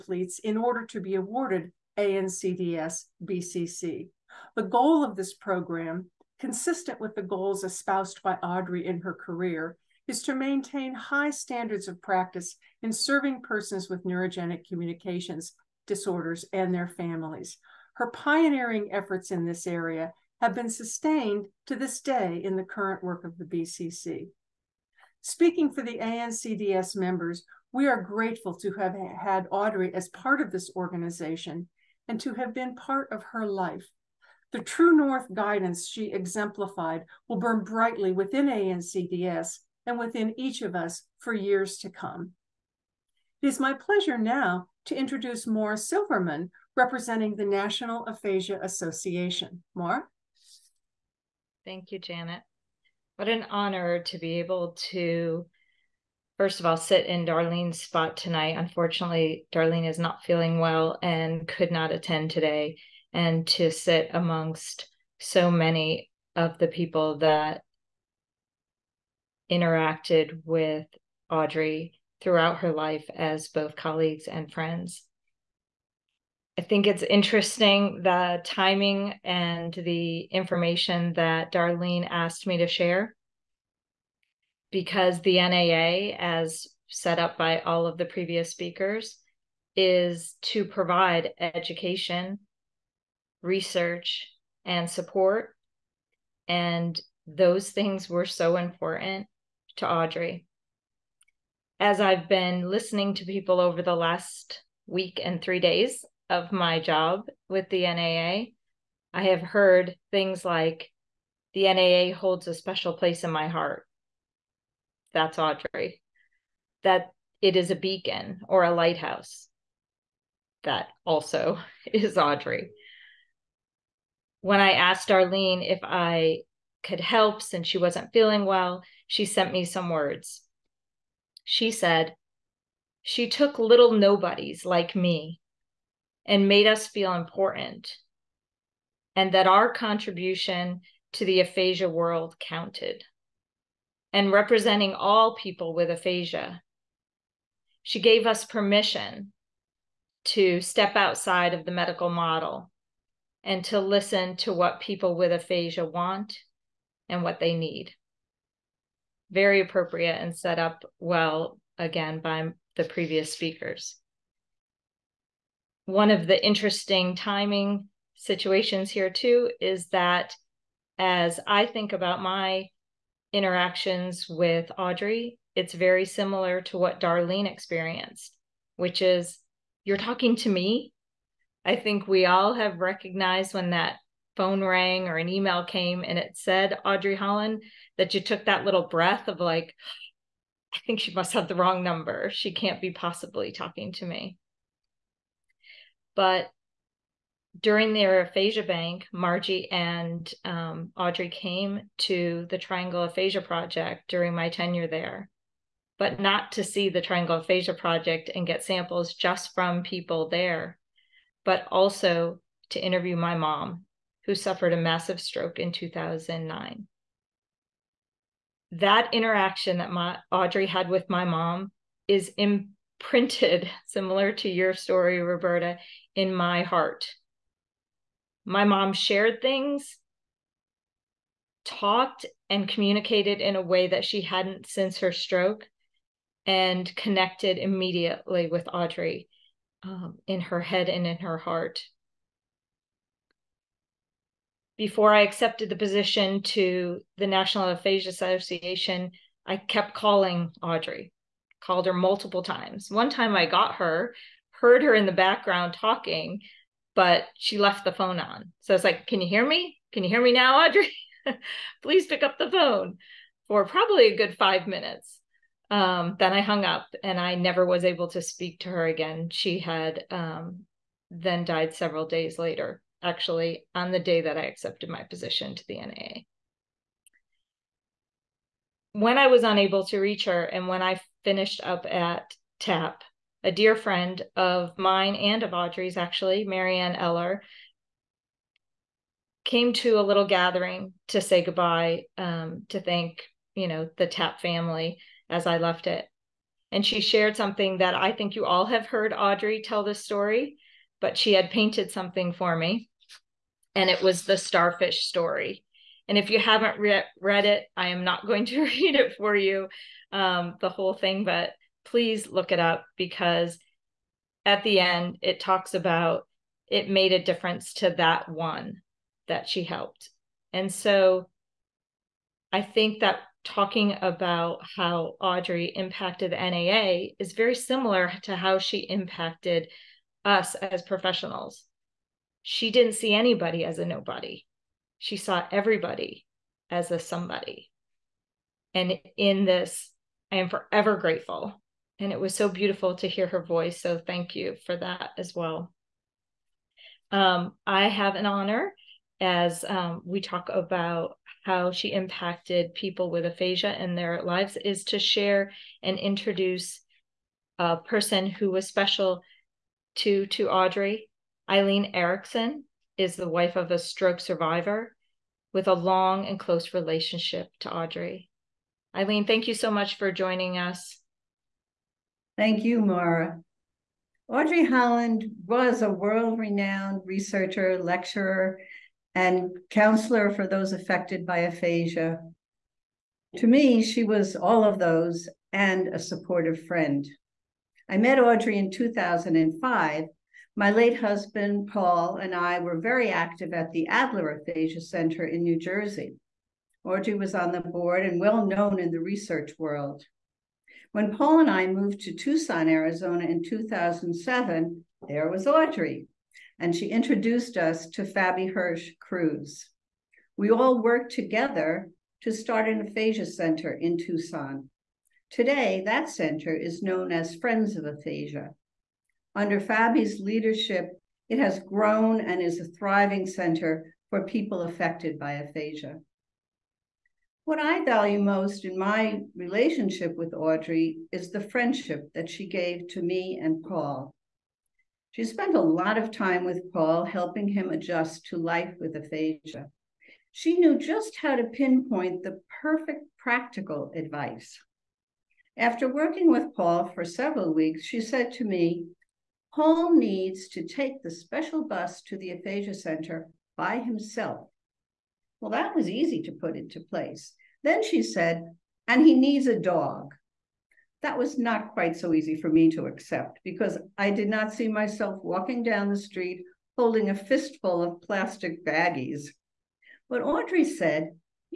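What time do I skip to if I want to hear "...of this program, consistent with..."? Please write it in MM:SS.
00:05.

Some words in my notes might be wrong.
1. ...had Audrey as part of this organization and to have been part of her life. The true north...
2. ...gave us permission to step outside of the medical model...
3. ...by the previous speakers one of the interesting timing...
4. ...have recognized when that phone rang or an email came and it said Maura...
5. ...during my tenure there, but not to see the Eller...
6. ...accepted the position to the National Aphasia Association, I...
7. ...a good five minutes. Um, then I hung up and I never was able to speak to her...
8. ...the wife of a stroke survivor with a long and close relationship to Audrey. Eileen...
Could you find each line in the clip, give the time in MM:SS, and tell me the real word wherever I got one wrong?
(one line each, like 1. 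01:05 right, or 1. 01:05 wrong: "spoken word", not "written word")
1. 00:28 right
2. 02:27 right
3. 02:42 right
4. 03:02 wrong: "Audrey", not "Maura"
5. 03:24 wrong: "Triangle", not "Eller"
6. 04:05 right
7. 04:24 right
8. 06:03 right.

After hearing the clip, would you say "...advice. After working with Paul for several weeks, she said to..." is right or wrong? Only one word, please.
right.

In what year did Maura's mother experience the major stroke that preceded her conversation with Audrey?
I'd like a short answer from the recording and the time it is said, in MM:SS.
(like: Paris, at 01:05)
2009, at 03:35.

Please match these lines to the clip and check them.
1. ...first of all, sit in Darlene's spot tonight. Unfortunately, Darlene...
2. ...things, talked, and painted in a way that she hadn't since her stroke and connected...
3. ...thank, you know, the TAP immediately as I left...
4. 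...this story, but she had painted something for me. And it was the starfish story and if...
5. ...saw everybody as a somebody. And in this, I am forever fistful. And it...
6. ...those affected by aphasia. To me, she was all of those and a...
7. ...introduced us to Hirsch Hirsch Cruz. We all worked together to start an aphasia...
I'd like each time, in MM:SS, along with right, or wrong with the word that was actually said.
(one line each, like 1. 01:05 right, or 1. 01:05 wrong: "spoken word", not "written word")
1. 00:56 right
2. 03:49 wrong: "communicated", not "painted"
3. 04:52 wrong: "family", not "immediately"
4. 04:59 right
5. 05:35 wrong: "grateful", not "fistful"
6. 06:20 right
7. 06:46 wrong: "Fabi", not "Hirsch".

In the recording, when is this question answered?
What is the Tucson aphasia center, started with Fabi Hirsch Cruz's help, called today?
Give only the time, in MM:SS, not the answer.
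06:57.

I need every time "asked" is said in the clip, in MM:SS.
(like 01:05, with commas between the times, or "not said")
01:22, 02:04.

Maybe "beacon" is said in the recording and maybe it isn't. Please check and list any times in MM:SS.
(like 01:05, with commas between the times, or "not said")
01:57.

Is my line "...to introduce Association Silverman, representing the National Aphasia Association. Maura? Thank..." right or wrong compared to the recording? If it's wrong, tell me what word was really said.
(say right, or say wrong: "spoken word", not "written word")
wrong: "Maura", not "Association".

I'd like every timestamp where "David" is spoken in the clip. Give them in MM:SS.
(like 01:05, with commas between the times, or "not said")
not said.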